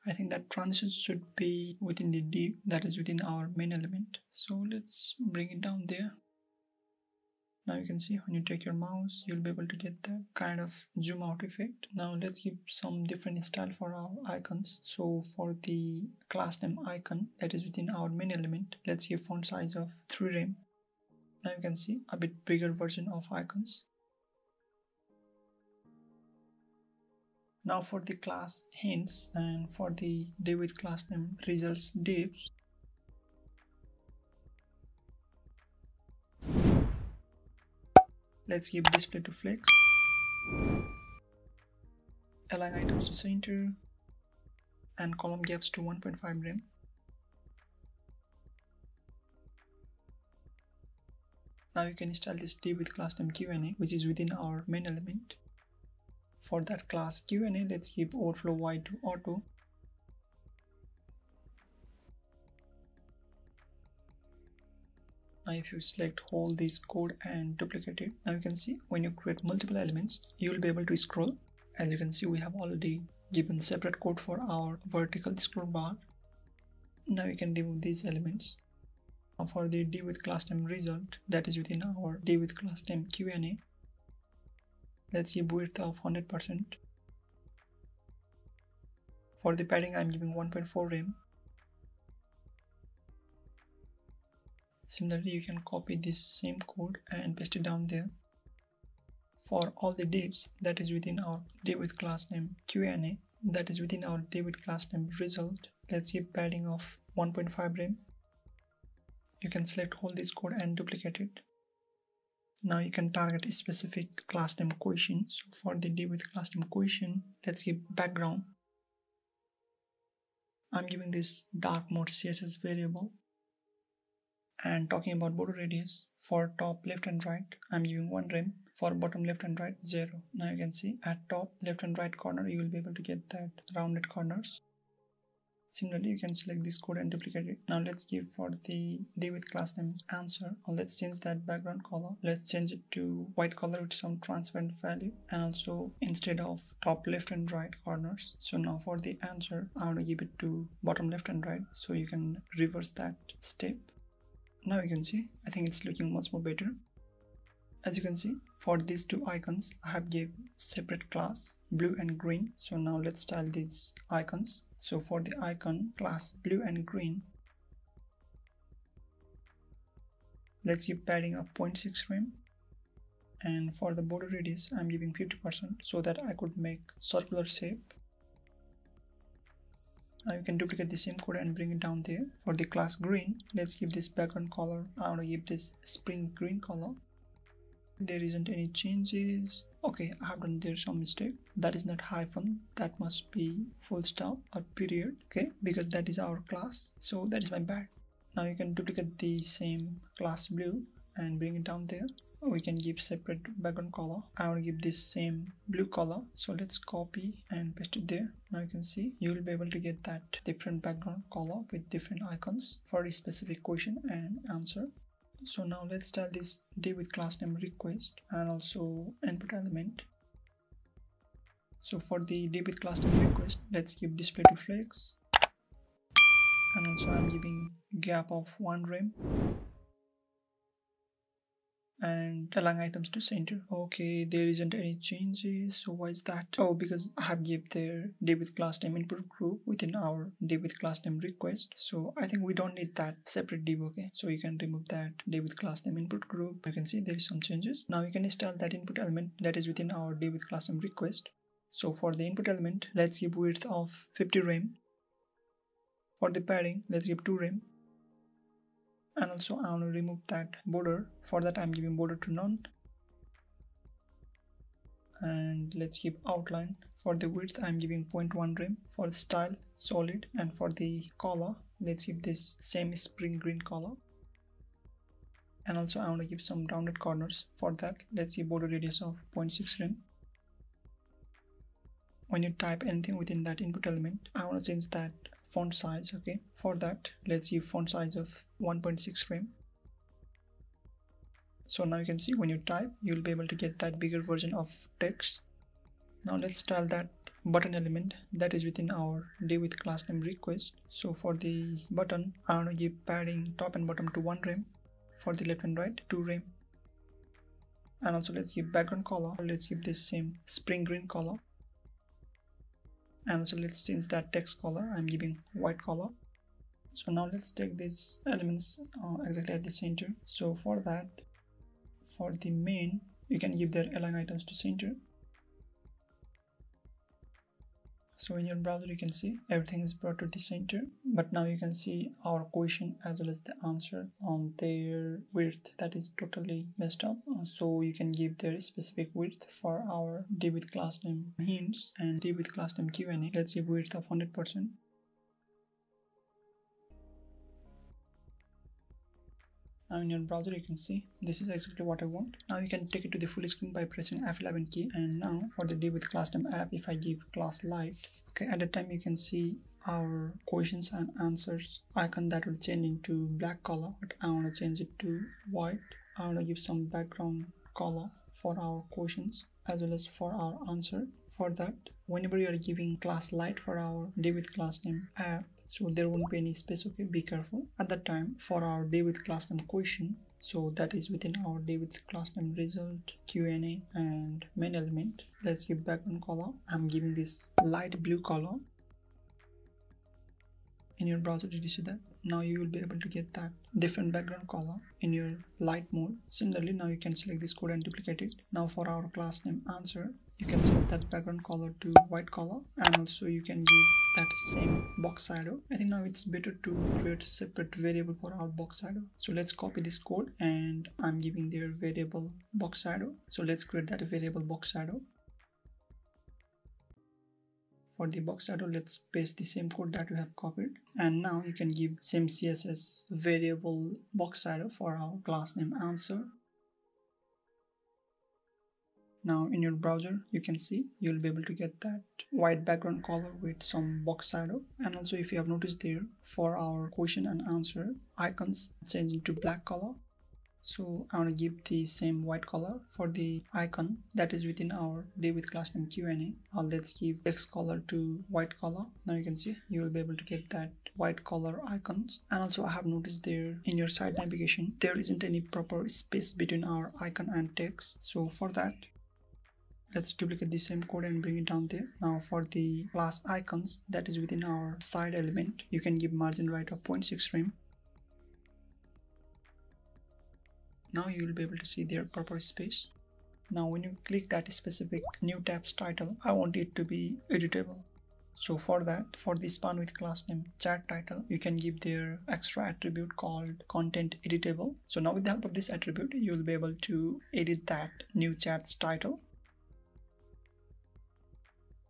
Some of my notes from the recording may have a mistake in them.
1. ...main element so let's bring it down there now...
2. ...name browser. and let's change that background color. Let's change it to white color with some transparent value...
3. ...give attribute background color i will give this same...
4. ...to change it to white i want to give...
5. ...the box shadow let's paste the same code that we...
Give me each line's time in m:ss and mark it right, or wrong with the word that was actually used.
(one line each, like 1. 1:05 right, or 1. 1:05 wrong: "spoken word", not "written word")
1. 0:03 right
2. 2:19 wrong: "answer", not "browser"
3. 3:22 wrong: "separate", not "attribute"
4. 6:04 right
5. 6:58 right.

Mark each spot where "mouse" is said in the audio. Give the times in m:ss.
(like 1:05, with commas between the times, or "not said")
0:08.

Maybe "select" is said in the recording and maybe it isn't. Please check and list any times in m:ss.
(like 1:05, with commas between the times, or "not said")
1:05, 1:49, 2:16, 6:37.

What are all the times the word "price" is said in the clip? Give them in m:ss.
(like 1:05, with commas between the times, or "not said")
not said.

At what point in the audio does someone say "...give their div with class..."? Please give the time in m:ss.
3:57.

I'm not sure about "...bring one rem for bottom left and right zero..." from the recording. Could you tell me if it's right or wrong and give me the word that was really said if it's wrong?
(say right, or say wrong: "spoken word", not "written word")
wrong: "giving", not "bring".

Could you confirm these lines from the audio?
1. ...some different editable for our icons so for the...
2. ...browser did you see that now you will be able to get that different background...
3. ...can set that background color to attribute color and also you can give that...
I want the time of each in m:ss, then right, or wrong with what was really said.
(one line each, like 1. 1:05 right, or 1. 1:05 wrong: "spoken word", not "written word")
1. 0:12 wrong: "style", not "editable"
2. 6:31 right
3. 6:40 wrong: "white", not "attribute".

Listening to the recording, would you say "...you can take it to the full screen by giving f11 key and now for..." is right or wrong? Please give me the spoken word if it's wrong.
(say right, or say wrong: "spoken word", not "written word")
wrong: "pressing", not "giving".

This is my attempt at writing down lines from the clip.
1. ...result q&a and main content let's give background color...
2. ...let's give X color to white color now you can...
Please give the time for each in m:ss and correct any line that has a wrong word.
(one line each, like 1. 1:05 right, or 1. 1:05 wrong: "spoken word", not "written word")
1. 6:22 wrong: "element", not "content"
2. 7:26 right.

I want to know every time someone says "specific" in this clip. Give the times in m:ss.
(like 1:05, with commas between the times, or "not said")
1:53, 3:33, 5:38, 7:54.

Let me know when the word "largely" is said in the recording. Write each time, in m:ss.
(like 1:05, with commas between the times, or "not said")
not said.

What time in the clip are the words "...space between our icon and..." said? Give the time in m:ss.
7:35.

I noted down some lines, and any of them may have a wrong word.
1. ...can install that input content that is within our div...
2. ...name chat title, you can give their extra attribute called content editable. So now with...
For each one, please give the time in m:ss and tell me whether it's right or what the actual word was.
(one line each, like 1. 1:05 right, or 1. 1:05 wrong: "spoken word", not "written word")
1. 4:08 wrong: "element", not "content"
2. 8:00 right.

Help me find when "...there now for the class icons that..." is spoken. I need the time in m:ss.
7:41.